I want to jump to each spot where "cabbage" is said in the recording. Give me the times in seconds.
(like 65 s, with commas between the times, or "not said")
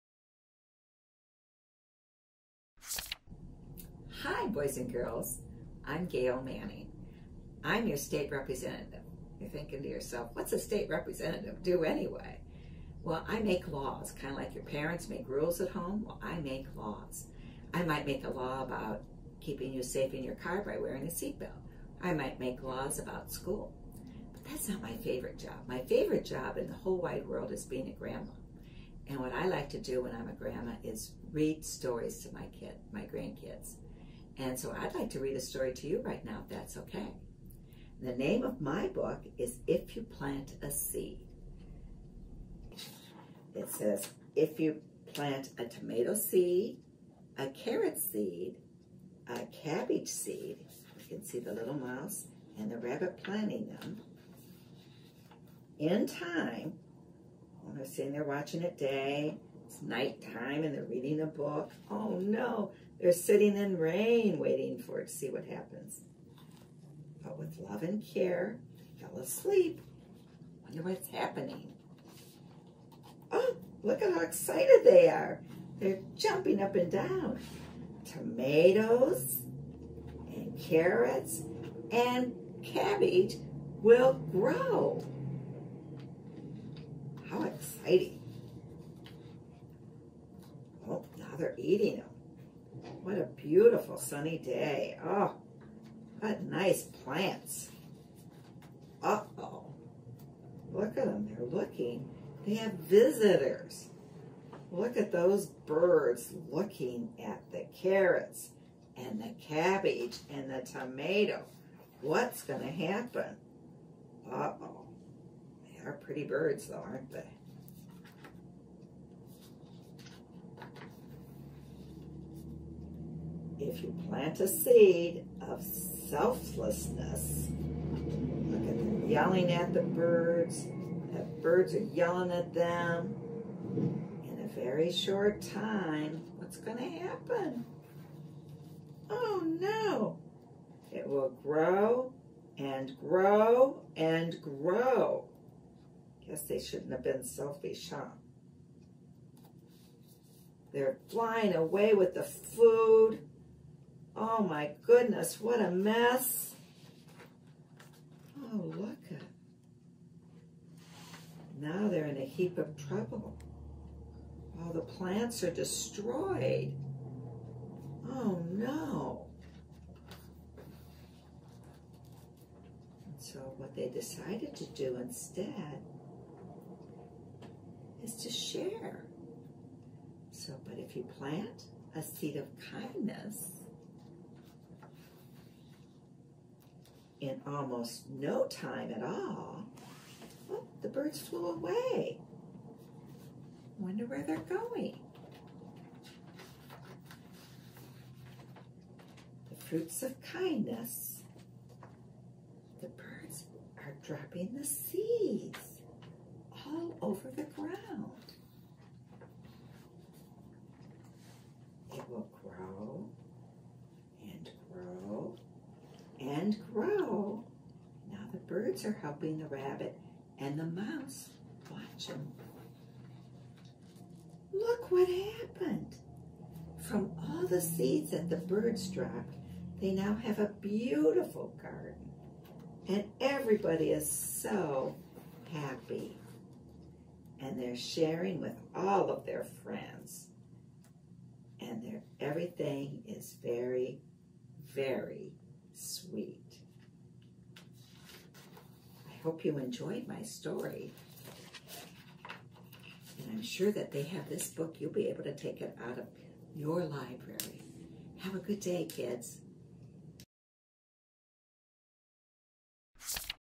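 49 s, 82 s, 109 s.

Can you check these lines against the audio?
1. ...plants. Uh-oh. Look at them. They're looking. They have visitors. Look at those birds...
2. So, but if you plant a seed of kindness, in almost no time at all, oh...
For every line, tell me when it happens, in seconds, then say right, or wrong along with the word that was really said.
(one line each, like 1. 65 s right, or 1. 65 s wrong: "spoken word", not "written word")
1. 96 s right
2. 180 s right.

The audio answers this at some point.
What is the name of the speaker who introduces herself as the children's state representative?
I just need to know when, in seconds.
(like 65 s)
6 s.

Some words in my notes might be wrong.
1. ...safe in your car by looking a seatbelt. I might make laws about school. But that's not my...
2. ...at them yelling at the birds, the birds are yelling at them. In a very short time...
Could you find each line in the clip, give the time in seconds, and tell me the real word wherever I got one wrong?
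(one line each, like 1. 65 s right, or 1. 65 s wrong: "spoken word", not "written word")
1. 19 s wrong: "wearing", not "looking"
2. 128 s right.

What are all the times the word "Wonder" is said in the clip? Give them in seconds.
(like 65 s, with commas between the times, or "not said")
70 s, 193 s.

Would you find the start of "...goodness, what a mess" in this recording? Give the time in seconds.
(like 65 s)
154 s.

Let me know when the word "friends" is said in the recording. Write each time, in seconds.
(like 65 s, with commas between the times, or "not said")
239 s.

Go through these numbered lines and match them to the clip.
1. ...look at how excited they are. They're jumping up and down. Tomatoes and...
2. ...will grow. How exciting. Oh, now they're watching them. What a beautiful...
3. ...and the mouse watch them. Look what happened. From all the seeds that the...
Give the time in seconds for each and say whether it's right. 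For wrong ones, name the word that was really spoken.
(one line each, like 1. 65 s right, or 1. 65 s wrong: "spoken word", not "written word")
1. 73 s right
2. 83 s wrong: "eating", not "watching"
3. 220 s right.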